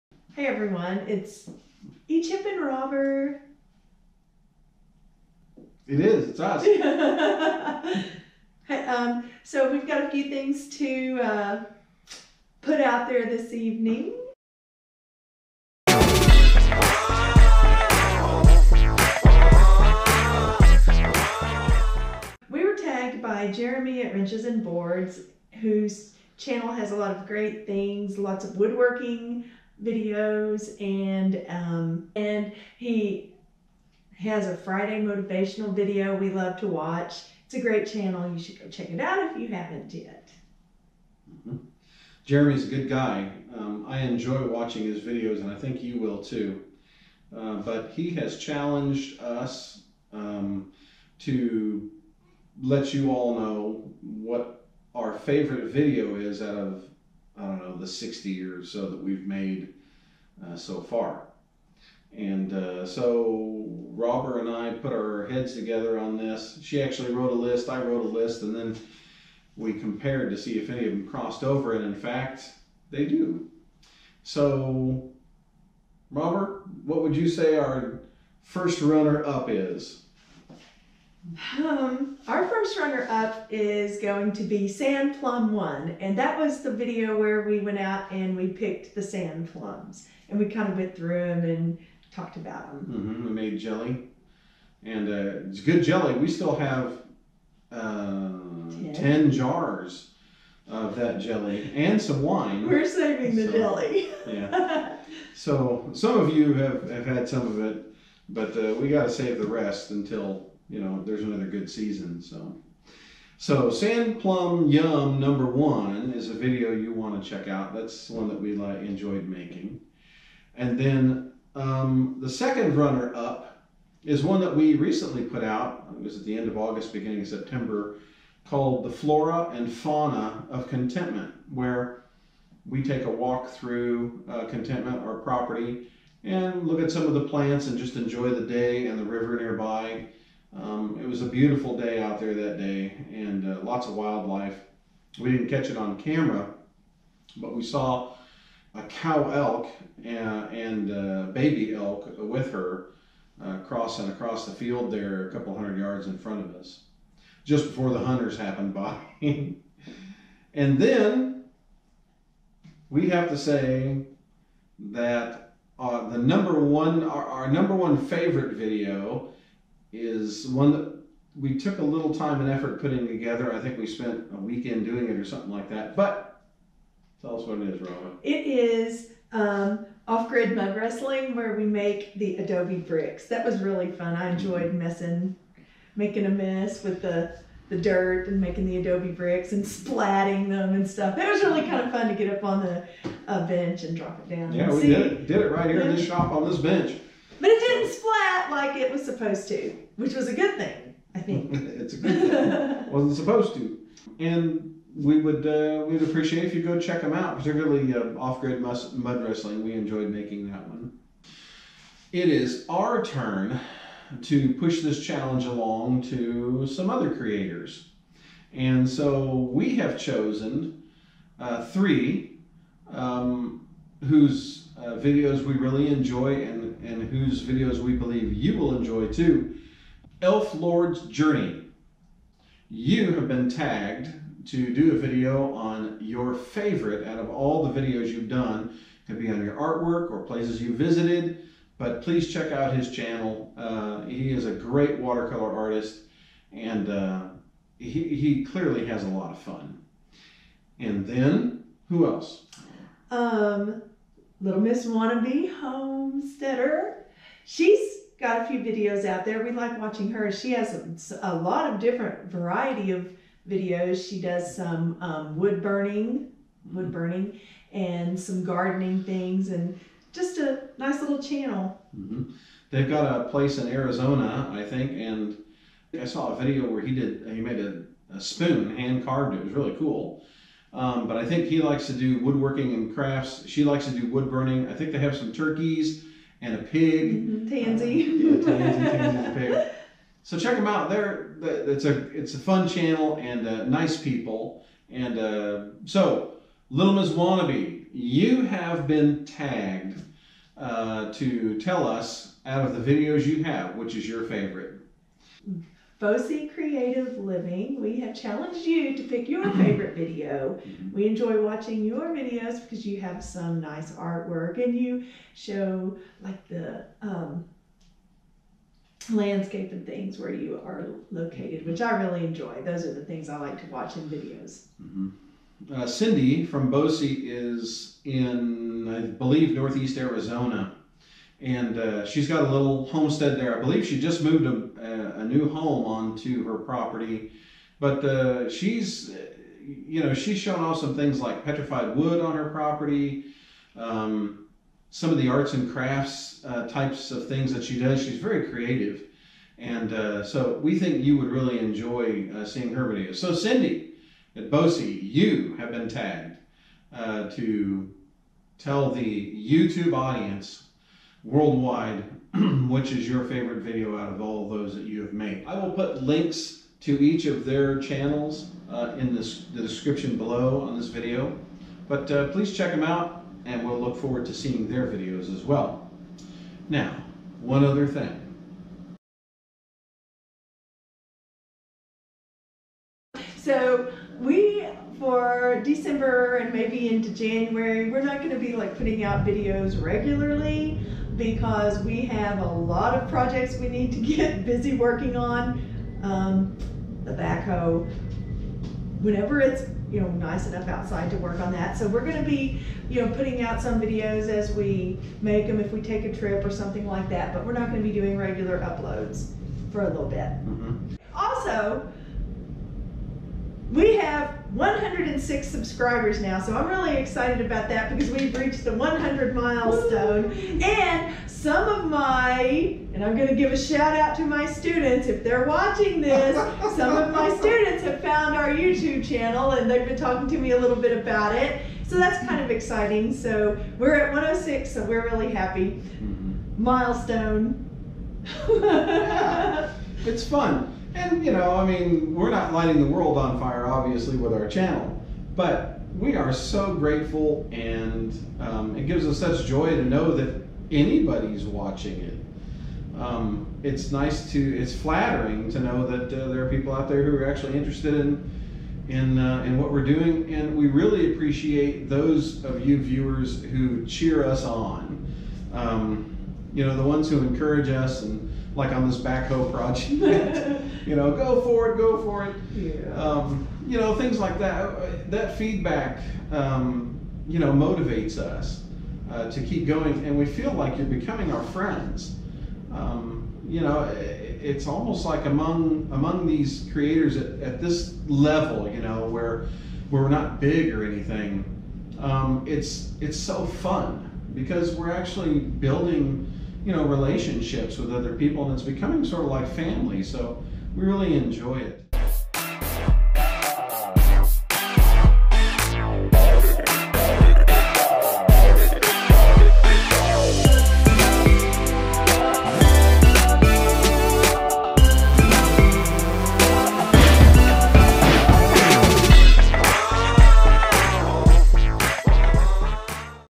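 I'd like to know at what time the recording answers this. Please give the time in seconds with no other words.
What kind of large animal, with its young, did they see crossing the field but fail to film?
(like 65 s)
148 s.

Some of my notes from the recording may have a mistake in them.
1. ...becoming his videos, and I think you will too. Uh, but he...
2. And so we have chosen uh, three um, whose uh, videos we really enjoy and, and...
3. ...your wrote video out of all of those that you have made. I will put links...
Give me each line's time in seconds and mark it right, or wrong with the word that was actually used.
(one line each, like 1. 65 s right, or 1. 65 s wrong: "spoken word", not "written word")
1. 44 s wrong: "watching", not "becoming"
2. 218 s right
3. 363 s wrong: "favorite", not "wrote".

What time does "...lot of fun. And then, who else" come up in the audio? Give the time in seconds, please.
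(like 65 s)
249 s.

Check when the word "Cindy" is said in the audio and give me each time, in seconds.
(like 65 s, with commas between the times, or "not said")
325 s, 353 s.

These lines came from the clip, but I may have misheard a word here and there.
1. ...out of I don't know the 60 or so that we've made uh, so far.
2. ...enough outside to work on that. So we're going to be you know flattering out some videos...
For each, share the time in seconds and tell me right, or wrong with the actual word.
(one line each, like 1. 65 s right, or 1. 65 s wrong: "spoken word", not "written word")
1. 56 s right
2. 400 s wrong: "putting", not "flattering".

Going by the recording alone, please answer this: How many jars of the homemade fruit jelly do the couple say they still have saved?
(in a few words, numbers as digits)
10.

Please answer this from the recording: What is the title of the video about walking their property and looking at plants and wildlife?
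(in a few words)
The Flora and Fauna of Contentment.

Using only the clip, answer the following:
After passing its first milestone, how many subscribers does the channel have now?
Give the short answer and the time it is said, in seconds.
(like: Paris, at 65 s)
106, at 414 s.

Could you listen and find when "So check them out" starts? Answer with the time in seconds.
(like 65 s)
290 s.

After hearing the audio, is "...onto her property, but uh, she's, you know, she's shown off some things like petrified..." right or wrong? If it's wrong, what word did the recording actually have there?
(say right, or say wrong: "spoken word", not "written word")
right.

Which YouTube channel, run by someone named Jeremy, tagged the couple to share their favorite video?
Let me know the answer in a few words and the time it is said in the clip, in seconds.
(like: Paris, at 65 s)
Wrenches and Boards, at 24 s.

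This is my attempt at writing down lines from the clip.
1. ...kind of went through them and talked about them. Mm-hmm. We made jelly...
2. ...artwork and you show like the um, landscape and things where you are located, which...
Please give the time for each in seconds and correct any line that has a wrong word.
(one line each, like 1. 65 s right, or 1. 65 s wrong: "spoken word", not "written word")
1. 90 s right
2. 313 s right.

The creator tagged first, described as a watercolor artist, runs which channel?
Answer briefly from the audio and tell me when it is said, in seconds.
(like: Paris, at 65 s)
Elf Lord's Journey, at 230 s.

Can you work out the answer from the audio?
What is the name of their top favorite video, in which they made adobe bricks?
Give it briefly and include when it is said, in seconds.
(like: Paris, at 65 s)
Off Grid Mud Wrestling, at 180 s.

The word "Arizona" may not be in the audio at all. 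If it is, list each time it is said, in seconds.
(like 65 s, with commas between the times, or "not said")
273 s, 329 s.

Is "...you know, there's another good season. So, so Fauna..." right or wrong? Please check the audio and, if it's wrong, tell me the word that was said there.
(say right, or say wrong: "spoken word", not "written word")
wrong: "Sand", not "Fauna".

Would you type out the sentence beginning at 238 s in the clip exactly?
It could be on your artwork or places you visited, but please check out his channel.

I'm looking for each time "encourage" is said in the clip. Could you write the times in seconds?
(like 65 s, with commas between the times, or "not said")
467 s.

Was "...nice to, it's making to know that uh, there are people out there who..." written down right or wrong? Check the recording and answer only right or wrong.
wrong.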